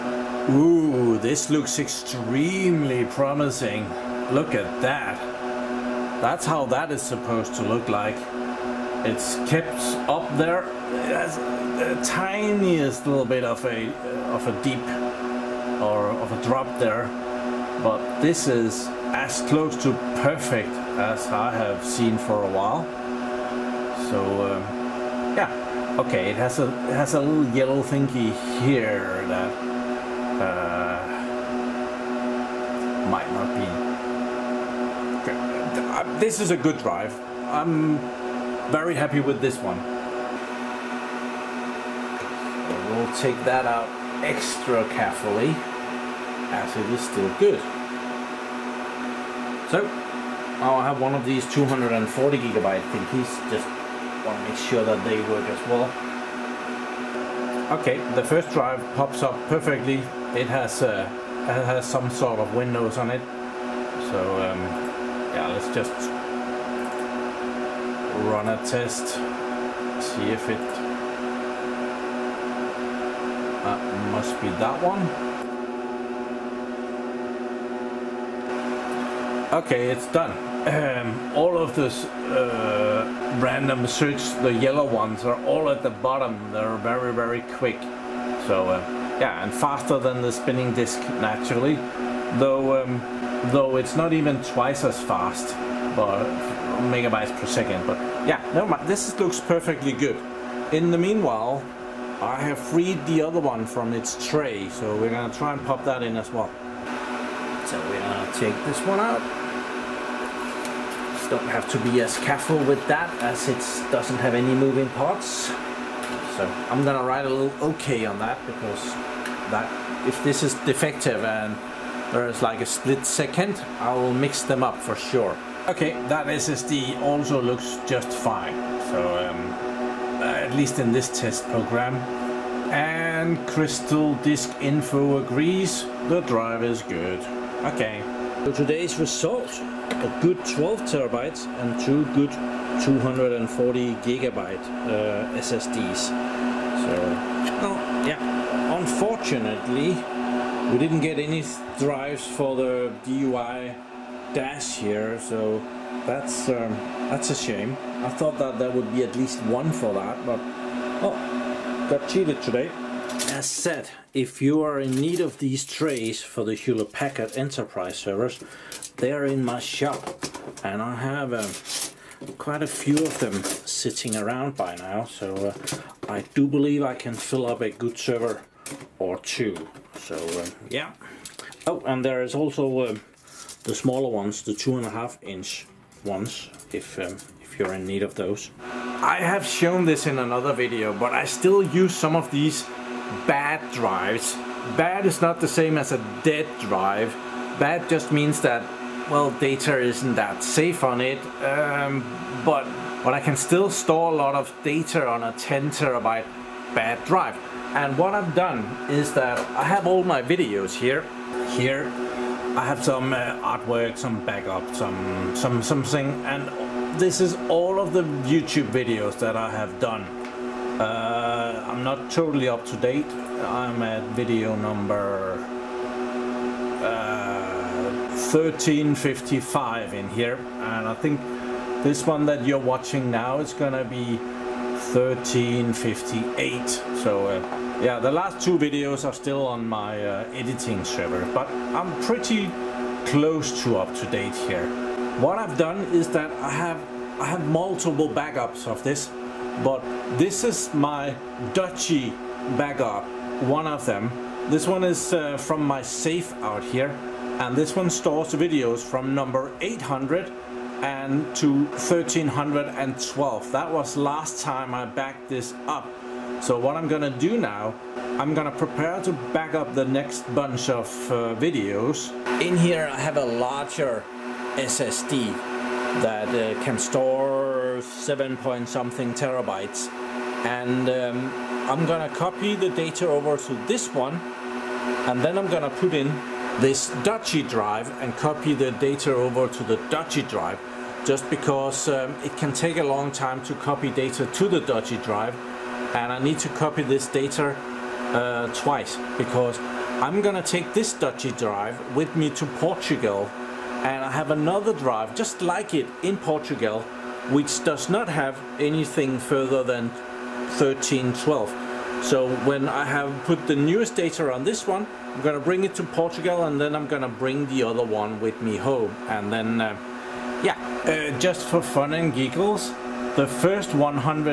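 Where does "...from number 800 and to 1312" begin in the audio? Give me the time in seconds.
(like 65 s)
258 s.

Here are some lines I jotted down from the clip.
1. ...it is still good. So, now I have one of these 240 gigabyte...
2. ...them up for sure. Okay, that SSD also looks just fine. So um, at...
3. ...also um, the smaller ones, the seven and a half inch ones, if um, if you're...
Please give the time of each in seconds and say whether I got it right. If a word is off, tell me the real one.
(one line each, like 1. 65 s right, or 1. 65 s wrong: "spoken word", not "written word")
1. 46 s right
2. 124 s right
3. 182 s wrong: "two", not "seven".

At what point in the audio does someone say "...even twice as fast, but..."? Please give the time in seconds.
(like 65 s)
94 s.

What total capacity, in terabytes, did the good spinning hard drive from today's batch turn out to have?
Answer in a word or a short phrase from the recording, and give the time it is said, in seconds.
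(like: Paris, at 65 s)
12 terabytes, at 140 s.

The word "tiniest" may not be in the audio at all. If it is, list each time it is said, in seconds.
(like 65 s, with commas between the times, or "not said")
12 s.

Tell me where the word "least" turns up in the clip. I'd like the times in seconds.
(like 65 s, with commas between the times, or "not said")
130 s, 159 s.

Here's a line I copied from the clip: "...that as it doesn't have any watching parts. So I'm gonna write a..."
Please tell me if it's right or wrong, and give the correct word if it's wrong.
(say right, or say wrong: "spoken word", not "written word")
wrong: "moving", not "watching".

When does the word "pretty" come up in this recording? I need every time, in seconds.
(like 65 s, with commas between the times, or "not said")
242 s.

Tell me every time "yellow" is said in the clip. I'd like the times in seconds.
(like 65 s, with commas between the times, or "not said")
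27 s, 84 s.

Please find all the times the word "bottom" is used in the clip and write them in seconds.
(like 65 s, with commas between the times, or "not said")
85 s.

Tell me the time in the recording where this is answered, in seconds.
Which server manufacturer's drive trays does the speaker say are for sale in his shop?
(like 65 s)
166 s.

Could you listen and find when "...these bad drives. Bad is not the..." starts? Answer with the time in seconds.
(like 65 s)
192 s.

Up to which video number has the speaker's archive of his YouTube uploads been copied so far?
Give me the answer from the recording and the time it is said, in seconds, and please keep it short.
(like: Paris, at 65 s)
1355, at 228 s.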